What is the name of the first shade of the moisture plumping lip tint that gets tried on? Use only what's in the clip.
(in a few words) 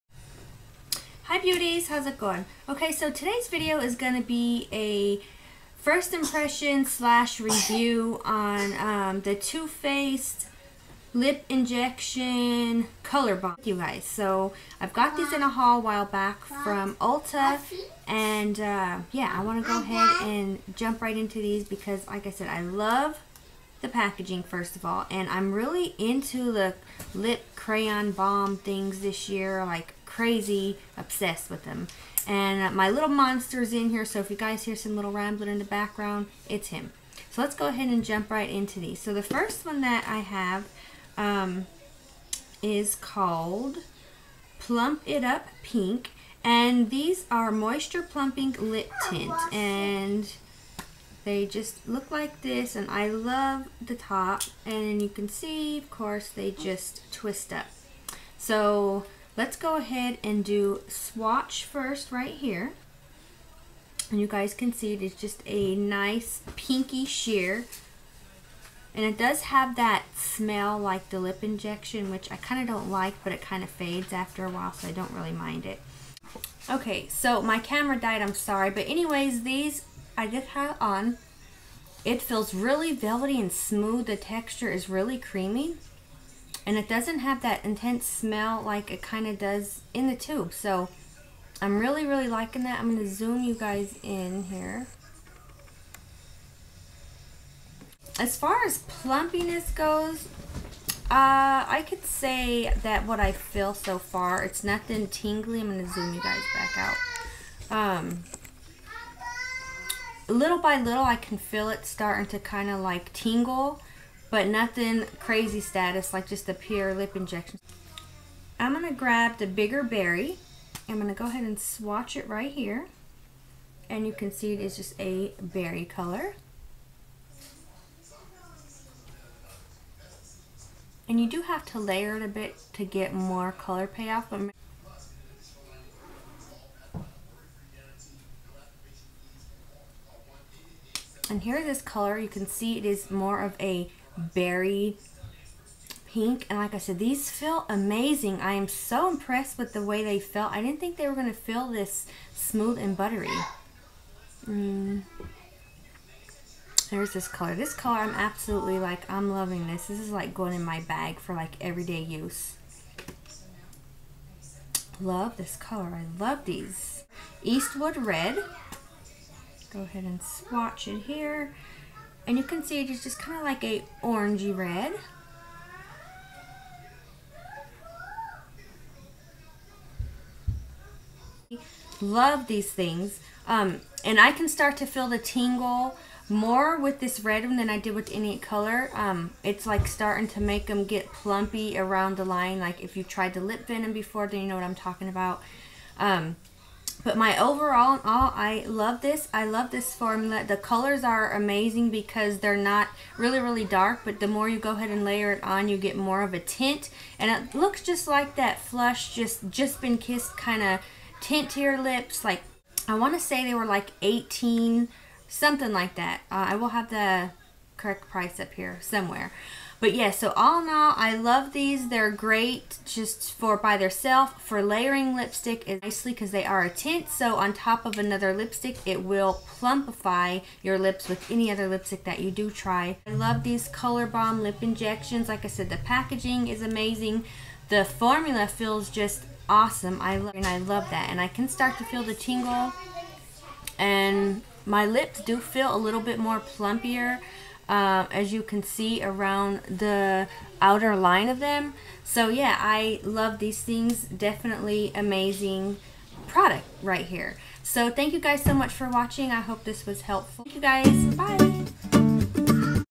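Plump It Up Pink.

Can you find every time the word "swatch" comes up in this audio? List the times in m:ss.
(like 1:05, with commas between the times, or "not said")
1:00, 2:01, 2:50.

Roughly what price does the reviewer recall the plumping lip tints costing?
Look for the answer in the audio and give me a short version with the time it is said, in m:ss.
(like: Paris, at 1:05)
18, at 3:34.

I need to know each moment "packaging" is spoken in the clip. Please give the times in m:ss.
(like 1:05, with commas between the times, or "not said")
0:23, 3:55.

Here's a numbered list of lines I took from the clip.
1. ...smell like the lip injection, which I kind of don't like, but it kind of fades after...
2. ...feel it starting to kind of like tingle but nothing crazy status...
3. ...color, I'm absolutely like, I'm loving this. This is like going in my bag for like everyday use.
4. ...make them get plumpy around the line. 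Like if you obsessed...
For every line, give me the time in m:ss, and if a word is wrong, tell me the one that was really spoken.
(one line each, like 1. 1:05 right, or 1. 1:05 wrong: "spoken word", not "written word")
1. 1:10 right
2. 1:51 right
3. 2:37 right
4. 3:10 wrong: "tried", not "obsessed".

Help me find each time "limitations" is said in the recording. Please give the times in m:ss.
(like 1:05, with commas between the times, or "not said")
not said.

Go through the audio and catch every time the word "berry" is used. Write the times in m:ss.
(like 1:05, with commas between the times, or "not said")
1:59, 2:05, 2:24.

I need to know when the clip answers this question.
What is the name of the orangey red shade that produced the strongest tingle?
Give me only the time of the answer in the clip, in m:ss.
2:47.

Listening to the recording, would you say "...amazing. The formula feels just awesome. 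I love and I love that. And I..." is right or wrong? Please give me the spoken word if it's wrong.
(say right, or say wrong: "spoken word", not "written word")
right.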